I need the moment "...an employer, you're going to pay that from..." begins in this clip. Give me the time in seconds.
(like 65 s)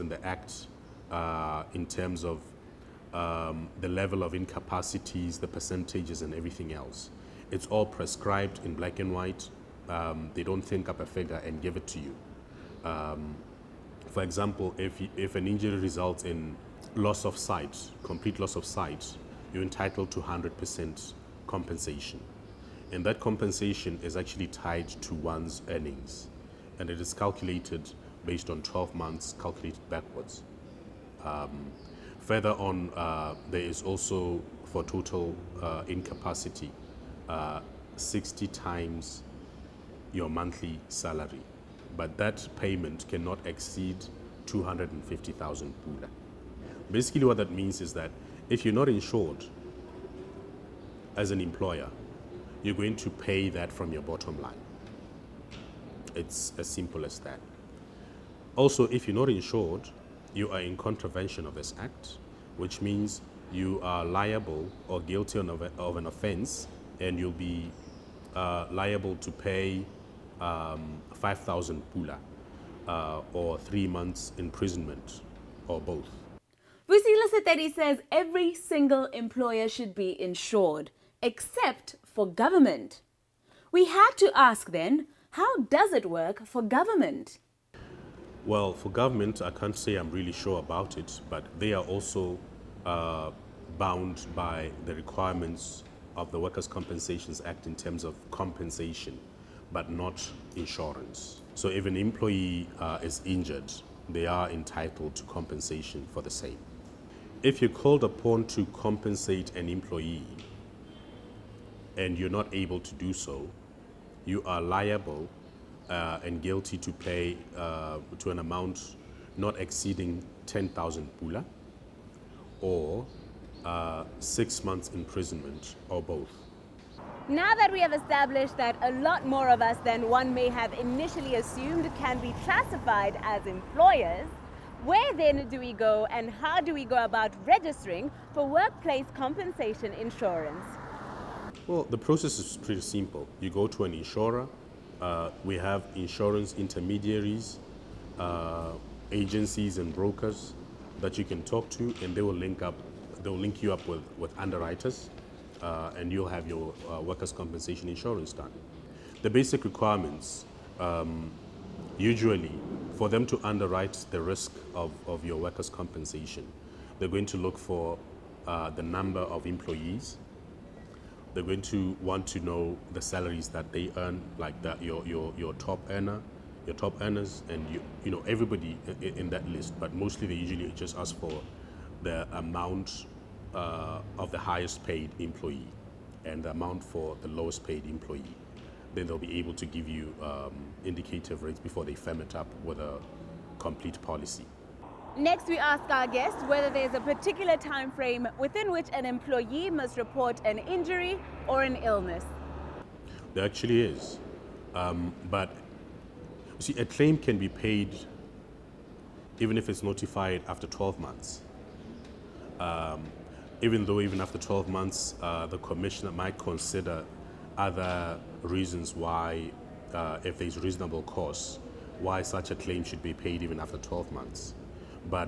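51 s.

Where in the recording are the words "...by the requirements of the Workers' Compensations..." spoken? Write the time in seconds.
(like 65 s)
94 s.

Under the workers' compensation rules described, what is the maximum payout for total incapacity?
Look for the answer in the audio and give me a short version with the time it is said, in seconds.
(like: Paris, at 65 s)
250,000 pula, at 44 s.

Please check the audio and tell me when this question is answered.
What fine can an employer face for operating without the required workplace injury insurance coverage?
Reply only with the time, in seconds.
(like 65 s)
71 s.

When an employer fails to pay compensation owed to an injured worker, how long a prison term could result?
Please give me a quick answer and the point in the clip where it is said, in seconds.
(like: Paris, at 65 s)
6 months, at 124 s.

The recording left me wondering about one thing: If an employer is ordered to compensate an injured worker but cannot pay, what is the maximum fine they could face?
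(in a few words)
10,000 pula.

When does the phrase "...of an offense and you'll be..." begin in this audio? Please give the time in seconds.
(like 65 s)
65 s.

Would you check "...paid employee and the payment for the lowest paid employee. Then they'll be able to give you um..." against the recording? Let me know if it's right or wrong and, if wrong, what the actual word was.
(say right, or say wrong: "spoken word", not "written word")
wrong: "amount", not "payment".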